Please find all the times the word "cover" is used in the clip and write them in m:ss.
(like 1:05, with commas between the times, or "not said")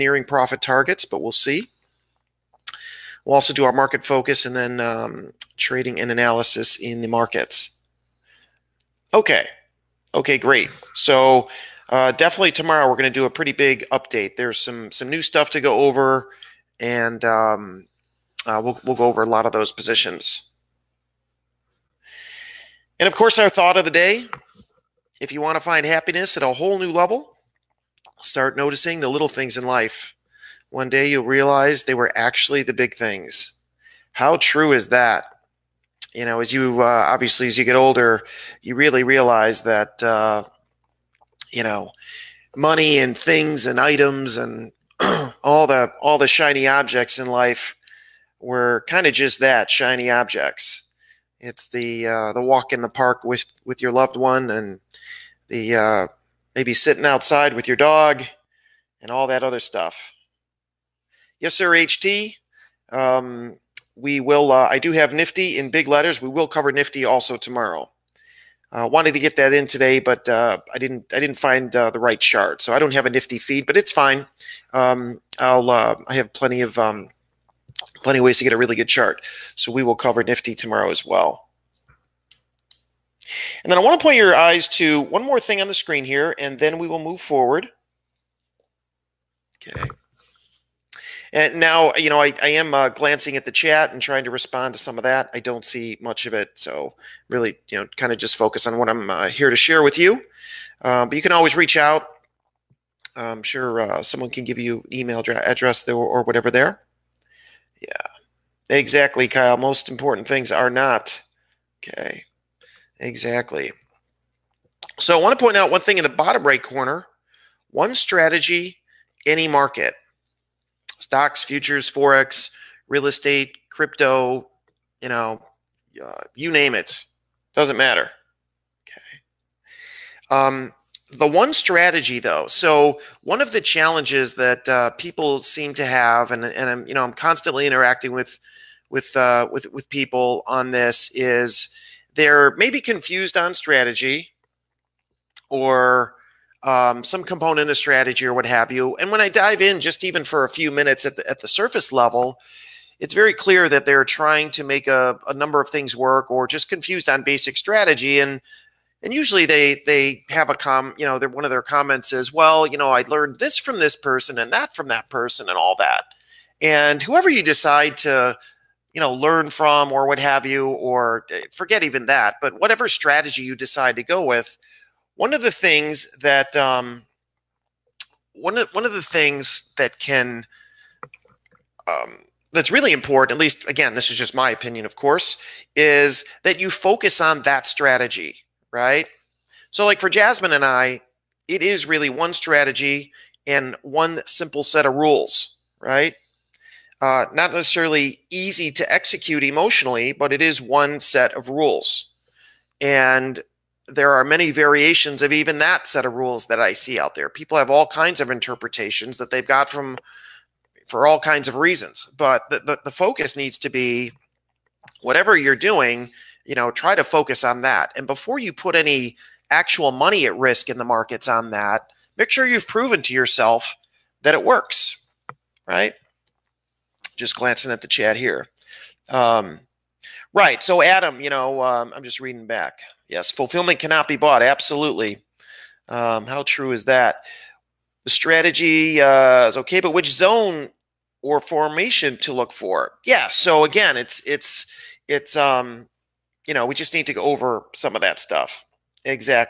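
1:06, 1:19.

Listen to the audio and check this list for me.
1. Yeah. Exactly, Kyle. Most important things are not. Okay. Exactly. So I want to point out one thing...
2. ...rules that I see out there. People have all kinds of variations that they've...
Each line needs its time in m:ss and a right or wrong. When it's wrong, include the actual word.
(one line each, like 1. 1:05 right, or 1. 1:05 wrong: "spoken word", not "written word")
1. 1:47 right
2. 3:26 wrong: "interpretations", not "variations".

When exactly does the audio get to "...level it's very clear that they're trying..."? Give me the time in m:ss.
2:31.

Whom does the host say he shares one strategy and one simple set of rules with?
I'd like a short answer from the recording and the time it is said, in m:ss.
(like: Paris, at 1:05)
Jasmine, at 3:10.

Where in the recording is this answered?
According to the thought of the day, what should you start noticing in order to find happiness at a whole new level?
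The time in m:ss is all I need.
0:29.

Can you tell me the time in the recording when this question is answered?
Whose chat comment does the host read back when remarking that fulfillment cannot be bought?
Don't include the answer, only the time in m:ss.
3:50.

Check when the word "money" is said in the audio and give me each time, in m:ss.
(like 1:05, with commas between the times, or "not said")
0:42, 3:39.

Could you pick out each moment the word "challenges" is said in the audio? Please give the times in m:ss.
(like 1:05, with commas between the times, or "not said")
2:13.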